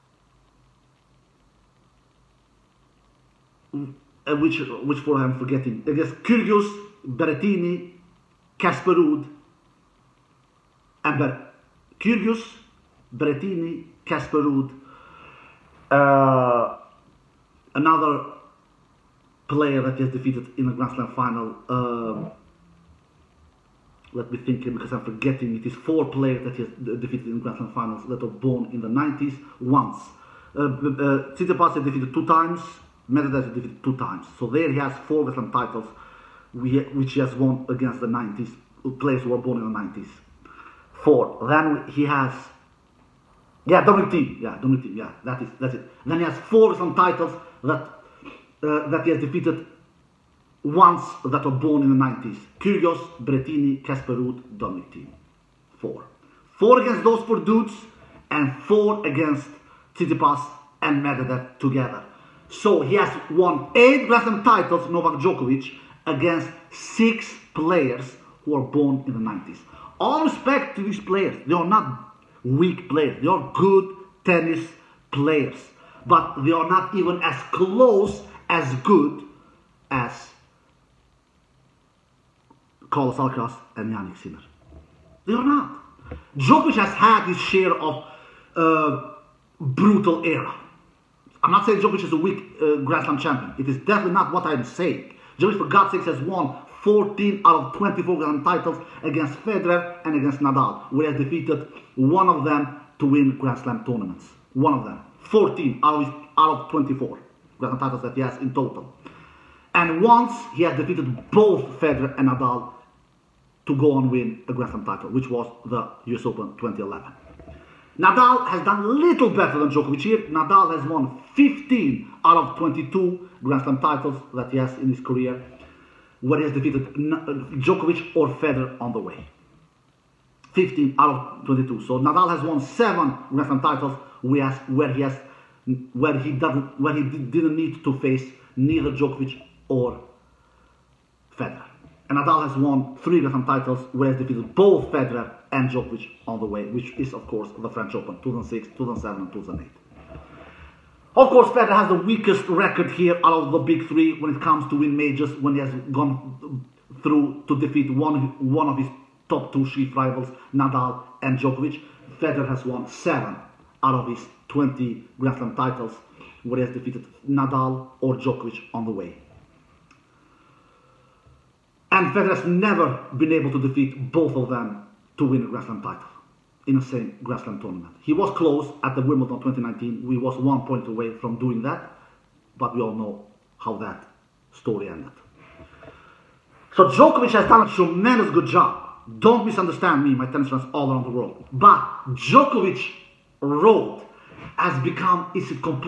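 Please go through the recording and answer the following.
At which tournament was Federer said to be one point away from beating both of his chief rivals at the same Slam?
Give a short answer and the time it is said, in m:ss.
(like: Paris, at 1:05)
Wimbledon 2019, at 2:59.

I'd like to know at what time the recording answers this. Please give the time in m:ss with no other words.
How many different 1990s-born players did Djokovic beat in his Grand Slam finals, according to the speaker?
1:06.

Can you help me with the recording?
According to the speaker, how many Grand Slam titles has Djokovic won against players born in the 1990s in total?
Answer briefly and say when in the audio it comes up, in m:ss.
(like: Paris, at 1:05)
8, at 1:03.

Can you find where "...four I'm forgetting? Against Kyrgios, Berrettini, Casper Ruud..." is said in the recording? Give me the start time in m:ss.
0:04.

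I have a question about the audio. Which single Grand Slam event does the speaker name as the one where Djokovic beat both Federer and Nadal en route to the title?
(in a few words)
US Open 2011.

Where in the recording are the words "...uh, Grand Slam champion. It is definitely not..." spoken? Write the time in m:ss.
1:32.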